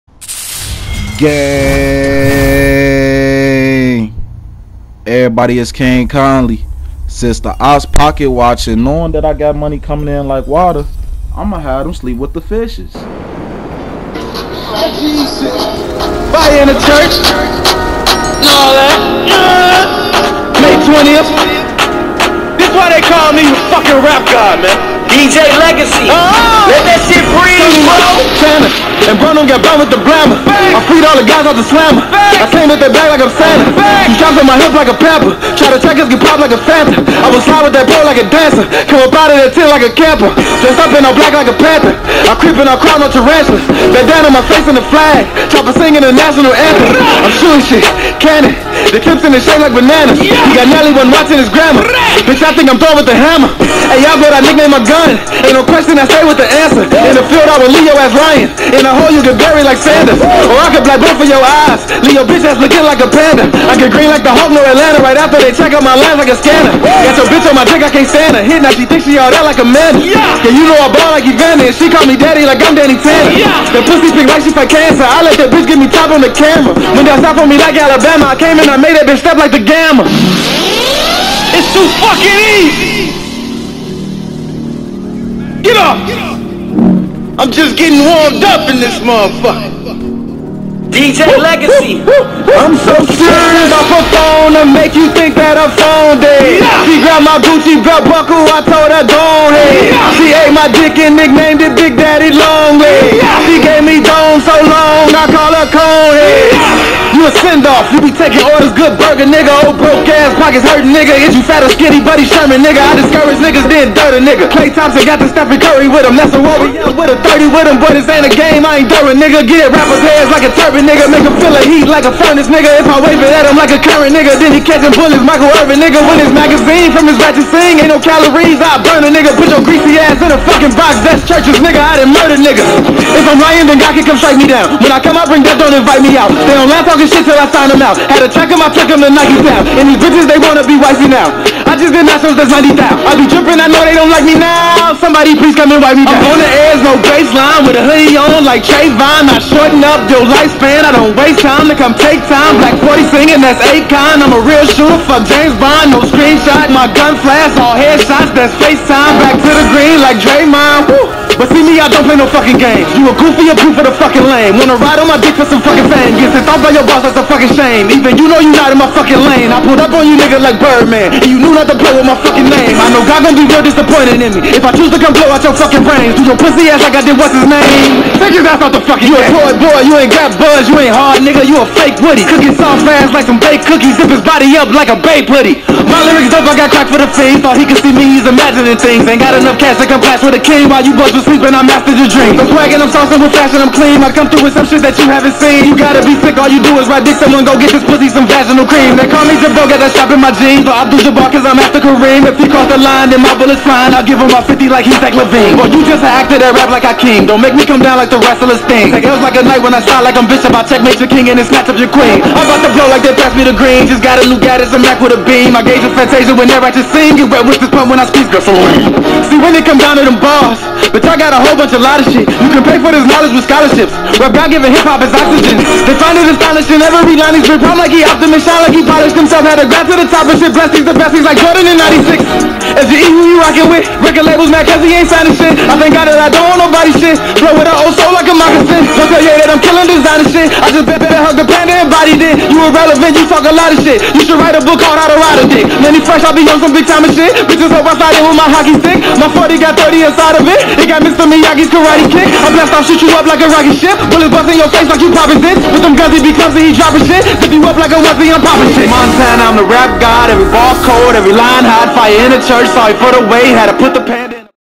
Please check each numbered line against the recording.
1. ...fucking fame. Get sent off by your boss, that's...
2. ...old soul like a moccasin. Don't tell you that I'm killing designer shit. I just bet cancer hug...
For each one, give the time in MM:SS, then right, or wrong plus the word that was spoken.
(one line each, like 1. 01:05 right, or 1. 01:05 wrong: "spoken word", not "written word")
1. 02:45 right
2. 03:57 wrong: "better", not "cancer".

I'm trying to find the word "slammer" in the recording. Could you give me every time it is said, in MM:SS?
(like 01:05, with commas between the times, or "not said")
00:31.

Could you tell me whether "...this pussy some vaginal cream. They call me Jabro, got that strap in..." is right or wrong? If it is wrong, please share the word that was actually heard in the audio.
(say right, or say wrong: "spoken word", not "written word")
right.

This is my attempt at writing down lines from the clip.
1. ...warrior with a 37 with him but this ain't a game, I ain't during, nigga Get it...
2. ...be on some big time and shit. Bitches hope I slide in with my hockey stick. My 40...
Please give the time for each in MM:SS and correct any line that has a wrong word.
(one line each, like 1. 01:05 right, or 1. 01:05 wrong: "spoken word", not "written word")
1. 01:56 wrong: "30", not "37"
2. 04:06 right.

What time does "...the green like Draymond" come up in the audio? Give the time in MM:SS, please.
02:39.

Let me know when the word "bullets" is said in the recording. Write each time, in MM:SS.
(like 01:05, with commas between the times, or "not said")
02:04, 03:23, 04:14.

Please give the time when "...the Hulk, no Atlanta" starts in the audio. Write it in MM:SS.
01:04.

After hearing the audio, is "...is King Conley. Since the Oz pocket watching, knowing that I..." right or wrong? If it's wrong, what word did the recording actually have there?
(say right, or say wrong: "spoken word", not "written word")
right.